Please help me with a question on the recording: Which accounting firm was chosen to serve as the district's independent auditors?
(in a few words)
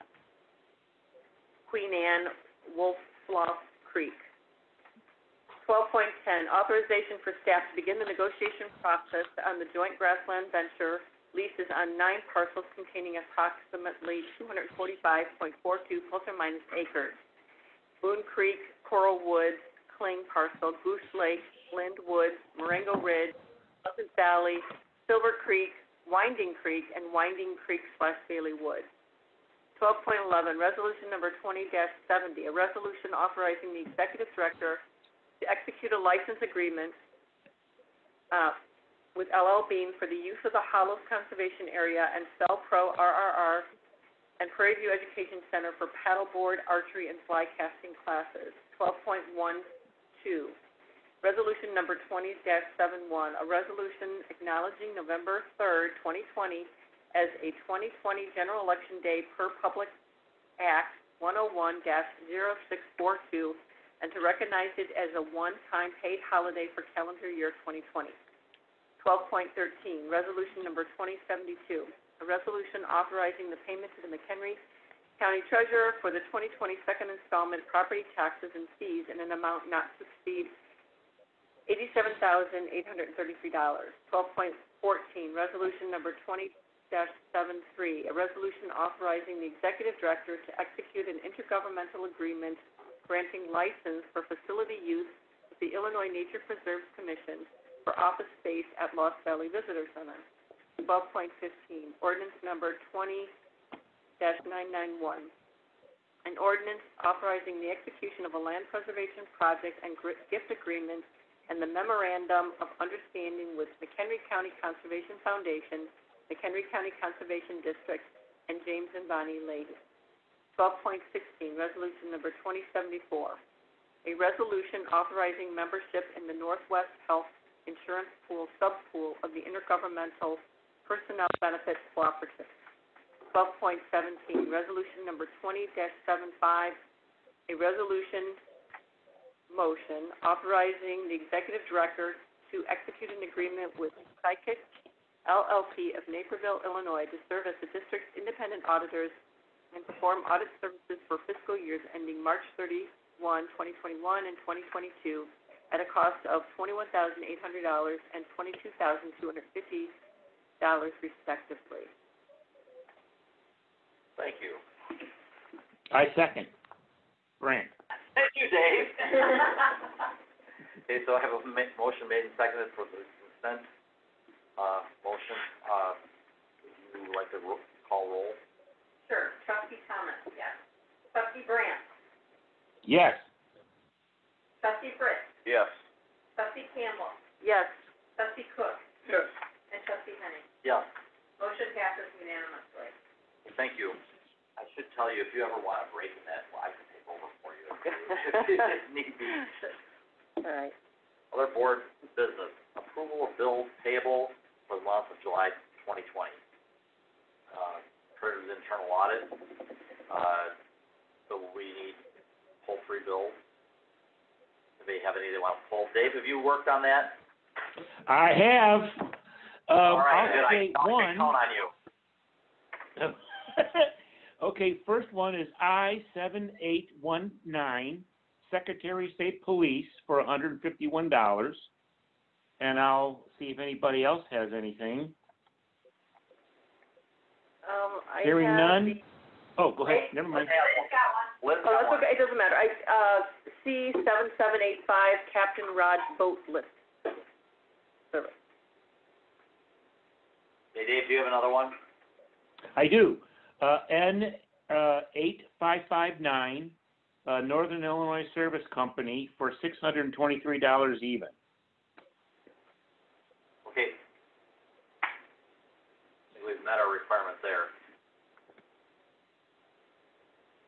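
Sikich LLP.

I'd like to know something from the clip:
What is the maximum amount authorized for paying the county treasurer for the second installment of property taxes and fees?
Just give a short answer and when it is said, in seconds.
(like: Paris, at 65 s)
$87,833, at 81 s.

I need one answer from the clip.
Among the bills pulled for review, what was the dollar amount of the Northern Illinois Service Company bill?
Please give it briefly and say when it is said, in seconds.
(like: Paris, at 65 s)
$623, at 259 s.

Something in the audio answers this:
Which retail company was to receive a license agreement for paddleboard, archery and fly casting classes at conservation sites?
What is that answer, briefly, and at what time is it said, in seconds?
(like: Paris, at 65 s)
LL Bean, at 39 s.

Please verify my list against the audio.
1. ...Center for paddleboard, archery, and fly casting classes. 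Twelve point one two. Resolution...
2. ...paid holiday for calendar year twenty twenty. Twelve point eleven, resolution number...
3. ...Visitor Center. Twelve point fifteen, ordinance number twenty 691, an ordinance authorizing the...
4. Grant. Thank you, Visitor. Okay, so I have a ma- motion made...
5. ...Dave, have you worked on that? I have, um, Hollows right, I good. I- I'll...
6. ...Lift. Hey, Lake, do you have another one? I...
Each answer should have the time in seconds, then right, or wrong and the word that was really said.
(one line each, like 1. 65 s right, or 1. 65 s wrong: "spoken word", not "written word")
1. 45 s right
2. 66 s wrong: "thirteen", not "eleven"
3. 99 s wrong: "991", not "691"
4. 167 s wrong: "Dave", not "Visitor"
5. 215 s wrong: "All", not "Hollows"
6. 246 s wrong: "Dave", not "Lake".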